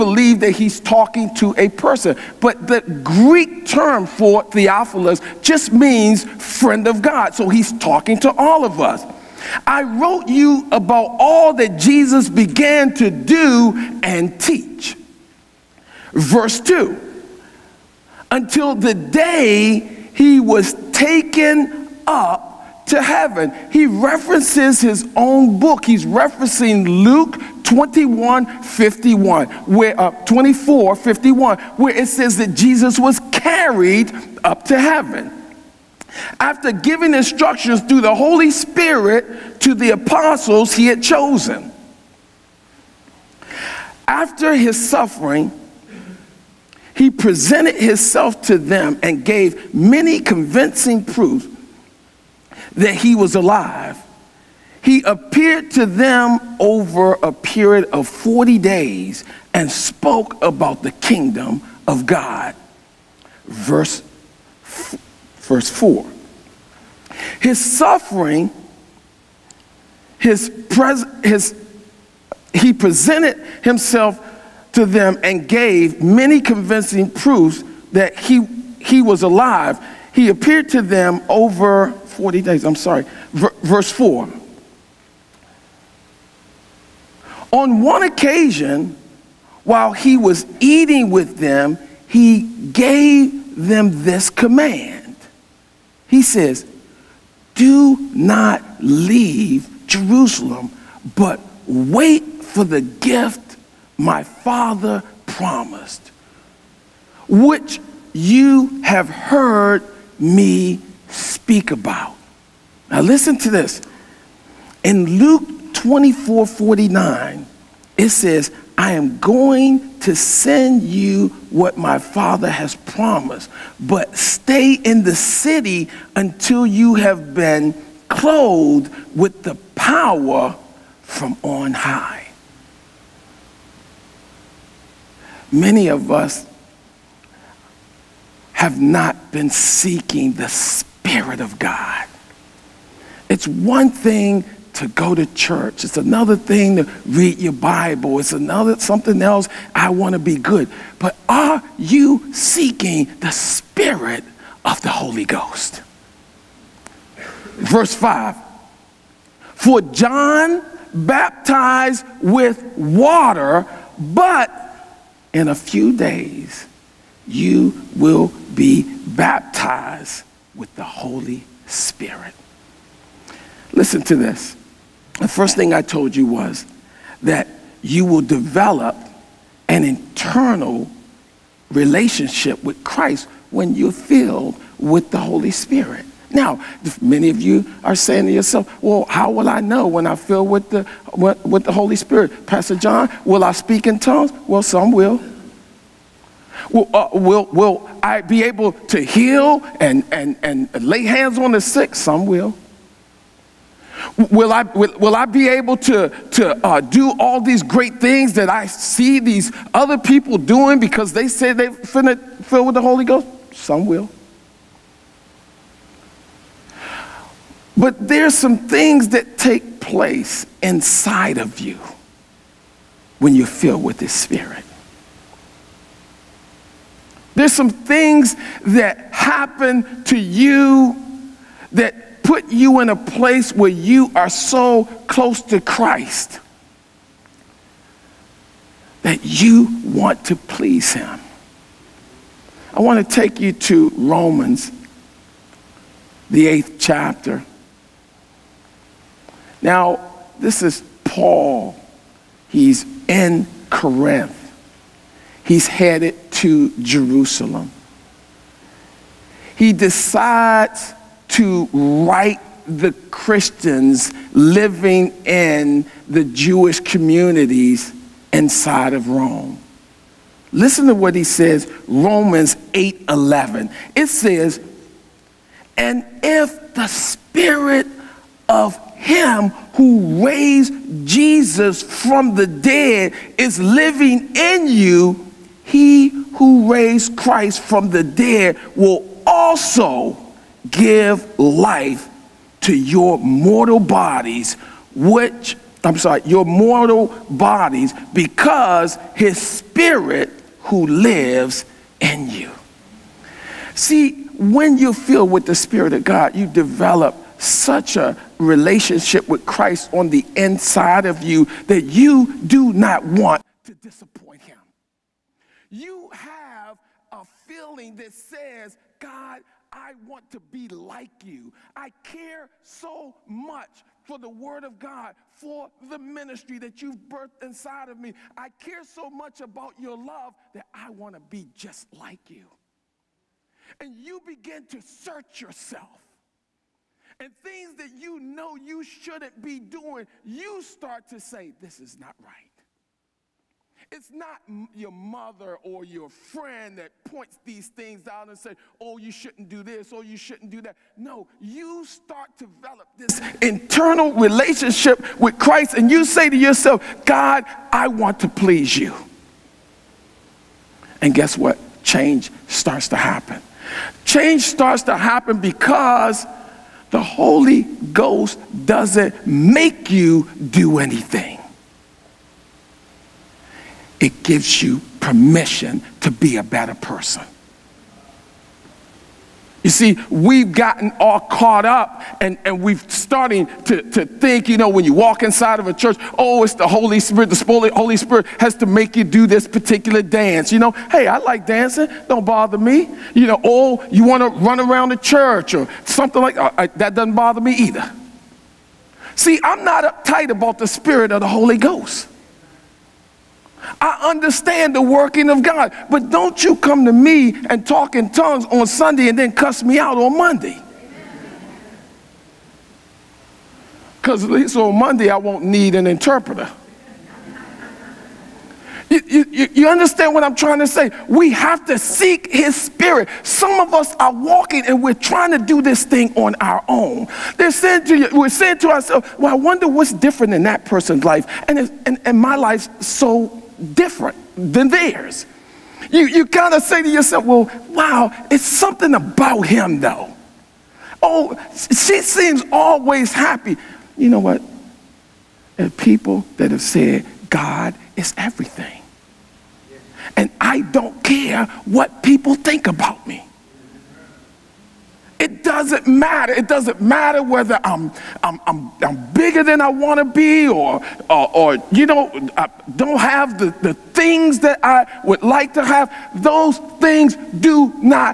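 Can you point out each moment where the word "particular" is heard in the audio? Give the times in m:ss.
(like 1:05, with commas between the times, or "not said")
6:29.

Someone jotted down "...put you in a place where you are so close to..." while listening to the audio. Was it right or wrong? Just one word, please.
right.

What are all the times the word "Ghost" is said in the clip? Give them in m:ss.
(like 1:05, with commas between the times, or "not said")
2:35, 3:33, 6:07, 6:41.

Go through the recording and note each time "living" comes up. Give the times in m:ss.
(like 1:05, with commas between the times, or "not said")
4:24, 4:43.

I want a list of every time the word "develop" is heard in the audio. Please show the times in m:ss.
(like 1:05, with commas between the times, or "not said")
2:58, 5:06, 5:52.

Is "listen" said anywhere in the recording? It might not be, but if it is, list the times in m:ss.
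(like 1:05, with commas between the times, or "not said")
1:53, 2:53, 4:30.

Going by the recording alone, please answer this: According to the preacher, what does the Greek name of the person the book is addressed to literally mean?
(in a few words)
friend of God.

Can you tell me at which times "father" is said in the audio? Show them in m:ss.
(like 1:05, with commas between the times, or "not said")
1:44, 2:01.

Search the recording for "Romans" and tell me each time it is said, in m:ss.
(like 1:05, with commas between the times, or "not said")
4:03, 4:31.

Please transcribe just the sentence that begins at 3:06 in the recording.
Now, many of you are saying to yourself, well, how will I know when I fill with the, with the Holy Spirit?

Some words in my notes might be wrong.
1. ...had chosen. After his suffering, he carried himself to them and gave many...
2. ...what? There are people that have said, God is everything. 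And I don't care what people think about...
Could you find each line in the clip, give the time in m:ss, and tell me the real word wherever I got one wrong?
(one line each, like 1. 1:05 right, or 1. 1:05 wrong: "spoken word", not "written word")
1. 0:40 wrong: "presented", not "carried"
2. 7:24 right.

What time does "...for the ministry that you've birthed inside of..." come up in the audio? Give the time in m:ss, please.
5:25.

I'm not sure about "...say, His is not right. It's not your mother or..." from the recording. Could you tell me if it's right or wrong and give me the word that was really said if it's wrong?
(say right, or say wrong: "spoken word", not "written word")
wrong: "This", not "His".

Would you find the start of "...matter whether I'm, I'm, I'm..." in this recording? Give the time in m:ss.
7:36.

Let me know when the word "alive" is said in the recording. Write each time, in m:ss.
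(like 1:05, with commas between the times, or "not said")
0:53, 1:19.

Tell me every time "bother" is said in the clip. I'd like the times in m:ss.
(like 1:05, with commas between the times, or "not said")
6:32, 6:37.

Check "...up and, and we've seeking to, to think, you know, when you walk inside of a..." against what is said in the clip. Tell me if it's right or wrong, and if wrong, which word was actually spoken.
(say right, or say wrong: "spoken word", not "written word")
wrong: "starting", not "seeking".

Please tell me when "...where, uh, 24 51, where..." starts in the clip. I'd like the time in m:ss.
0:29.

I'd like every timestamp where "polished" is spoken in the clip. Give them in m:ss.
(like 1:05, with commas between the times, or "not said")
not said.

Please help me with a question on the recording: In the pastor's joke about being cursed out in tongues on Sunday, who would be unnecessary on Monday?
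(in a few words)
an interpreter.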